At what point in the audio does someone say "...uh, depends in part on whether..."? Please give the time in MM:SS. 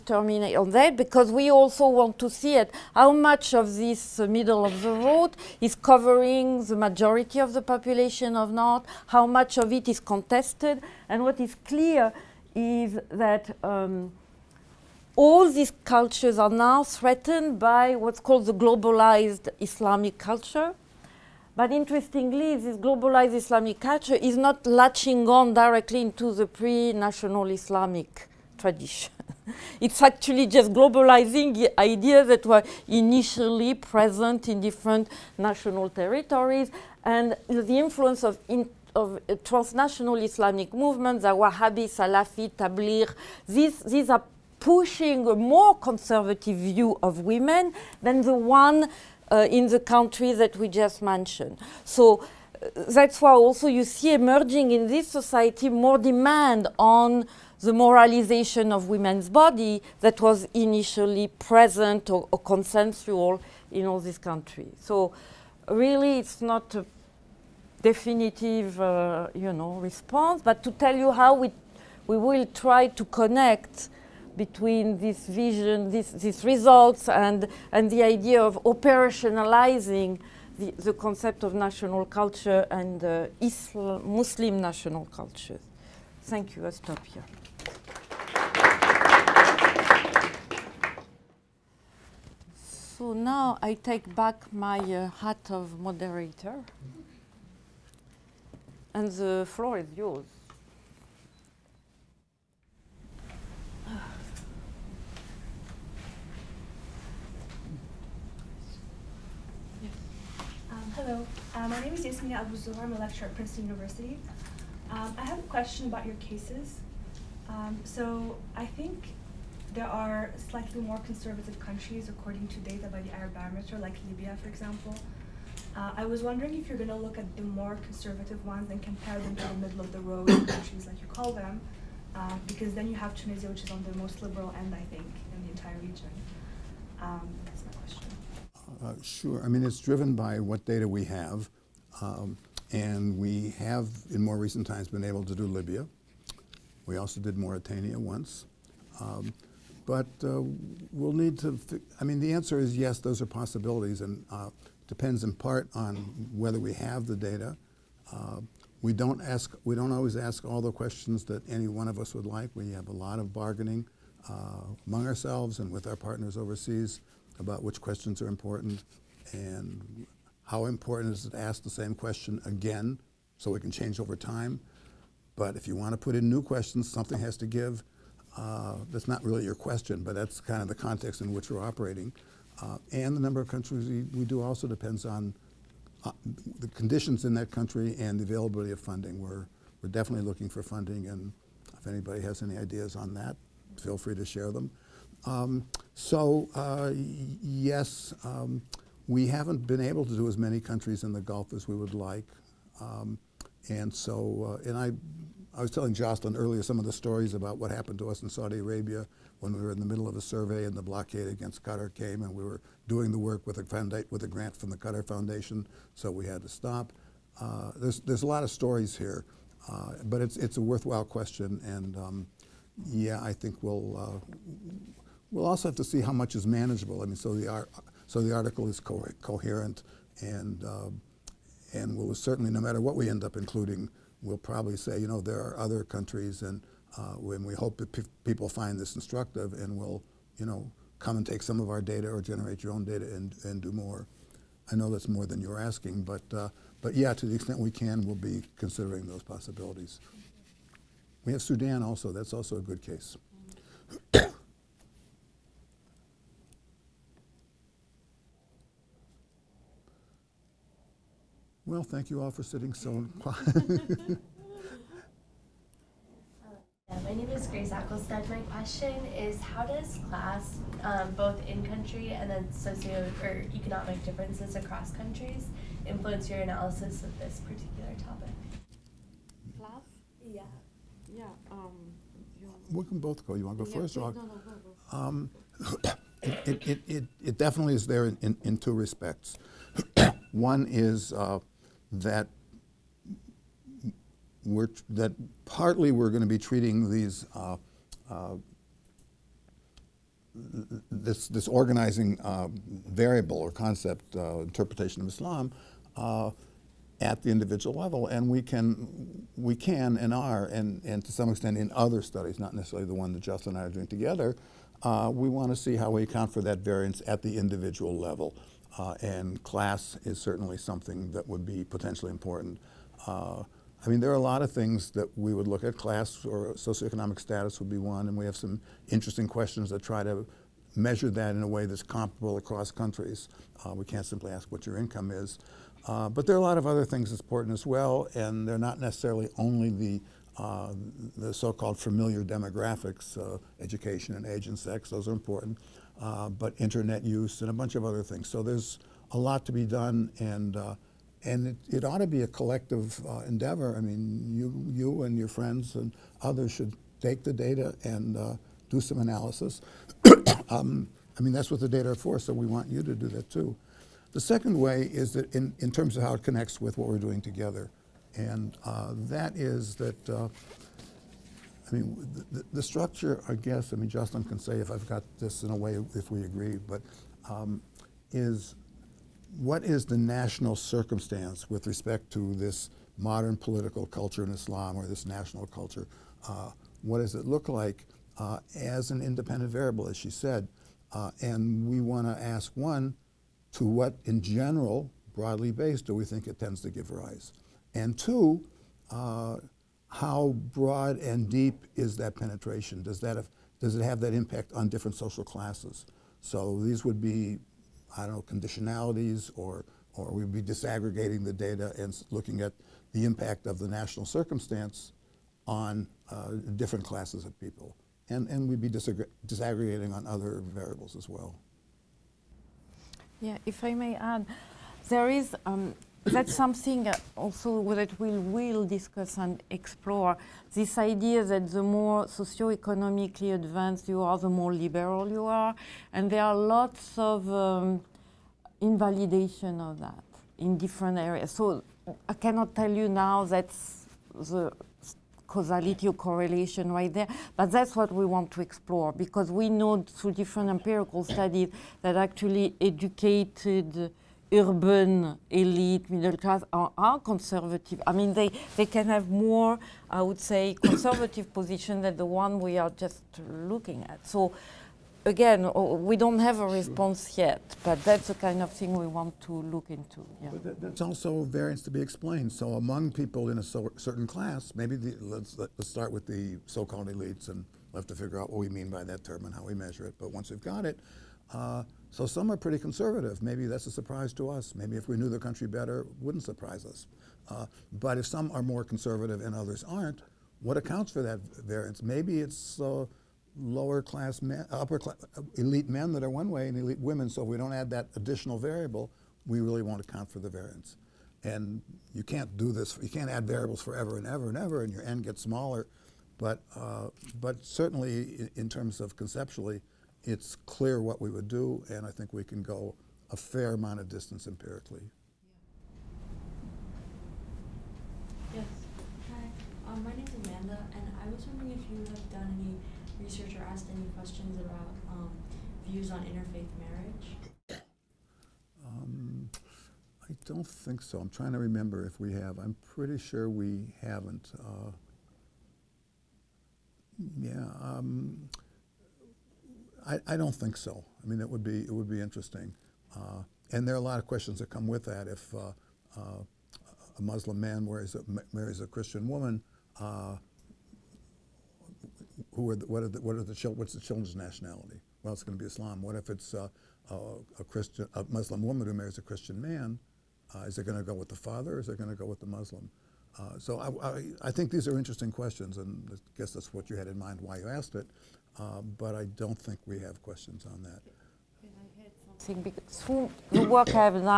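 02:34.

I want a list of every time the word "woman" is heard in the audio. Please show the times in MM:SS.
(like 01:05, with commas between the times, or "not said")
09:09, 09:18.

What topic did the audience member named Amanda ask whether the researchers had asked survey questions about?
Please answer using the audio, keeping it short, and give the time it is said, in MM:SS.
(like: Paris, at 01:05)
interfaith marriage, at 08:45.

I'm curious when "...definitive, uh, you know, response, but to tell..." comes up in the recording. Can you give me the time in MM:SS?
01:07.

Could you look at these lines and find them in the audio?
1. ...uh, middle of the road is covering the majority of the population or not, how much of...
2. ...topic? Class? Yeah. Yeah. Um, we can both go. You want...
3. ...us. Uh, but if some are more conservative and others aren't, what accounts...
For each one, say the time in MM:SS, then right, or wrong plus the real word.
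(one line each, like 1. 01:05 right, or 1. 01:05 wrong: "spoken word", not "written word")
1. 00:04 right
2. 04:38 right
3. 08:06 right.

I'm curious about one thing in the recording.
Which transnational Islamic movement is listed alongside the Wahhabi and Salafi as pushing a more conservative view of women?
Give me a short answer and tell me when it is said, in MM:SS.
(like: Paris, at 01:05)
Tablir, at 00:42.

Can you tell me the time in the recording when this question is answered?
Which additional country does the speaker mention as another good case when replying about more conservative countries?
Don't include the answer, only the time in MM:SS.
04:11.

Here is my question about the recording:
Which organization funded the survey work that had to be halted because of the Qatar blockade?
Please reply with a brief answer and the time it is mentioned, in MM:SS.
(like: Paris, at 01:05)
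Qatar Foundation, at 03:34.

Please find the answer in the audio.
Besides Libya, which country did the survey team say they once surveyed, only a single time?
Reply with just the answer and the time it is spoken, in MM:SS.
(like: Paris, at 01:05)
Mauritania, at 02:27.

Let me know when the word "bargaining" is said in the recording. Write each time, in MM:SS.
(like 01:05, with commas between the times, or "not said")
02:43.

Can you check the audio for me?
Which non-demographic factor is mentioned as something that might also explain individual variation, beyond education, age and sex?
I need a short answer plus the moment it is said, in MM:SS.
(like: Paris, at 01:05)
internet use, at 05:46.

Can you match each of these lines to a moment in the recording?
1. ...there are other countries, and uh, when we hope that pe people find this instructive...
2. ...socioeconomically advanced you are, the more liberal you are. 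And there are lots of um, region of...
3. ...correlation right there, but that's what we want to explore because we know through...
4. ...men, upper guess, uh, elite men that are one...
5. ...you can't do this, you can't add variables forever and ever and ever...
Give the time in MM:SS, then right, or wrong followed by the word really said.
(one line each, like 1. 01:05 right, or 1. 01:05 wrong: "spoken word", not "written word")
1. 03:55 right
2. 07:12 wrong: "invalidation", not "region"
3. 07:25 right
4. 08:14 wrong: "class", not "guess"
5. 08:21 right.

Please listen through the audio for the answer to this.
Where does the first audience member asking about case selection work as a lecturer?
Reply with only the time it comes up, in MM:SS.
01:53.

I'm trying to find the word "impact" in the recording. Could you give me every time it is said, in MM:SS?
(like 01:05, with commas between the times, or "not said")
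06:44, 06:53.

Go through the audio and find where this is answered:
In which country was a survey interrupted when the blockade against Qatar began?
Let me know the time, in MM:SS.
03:28.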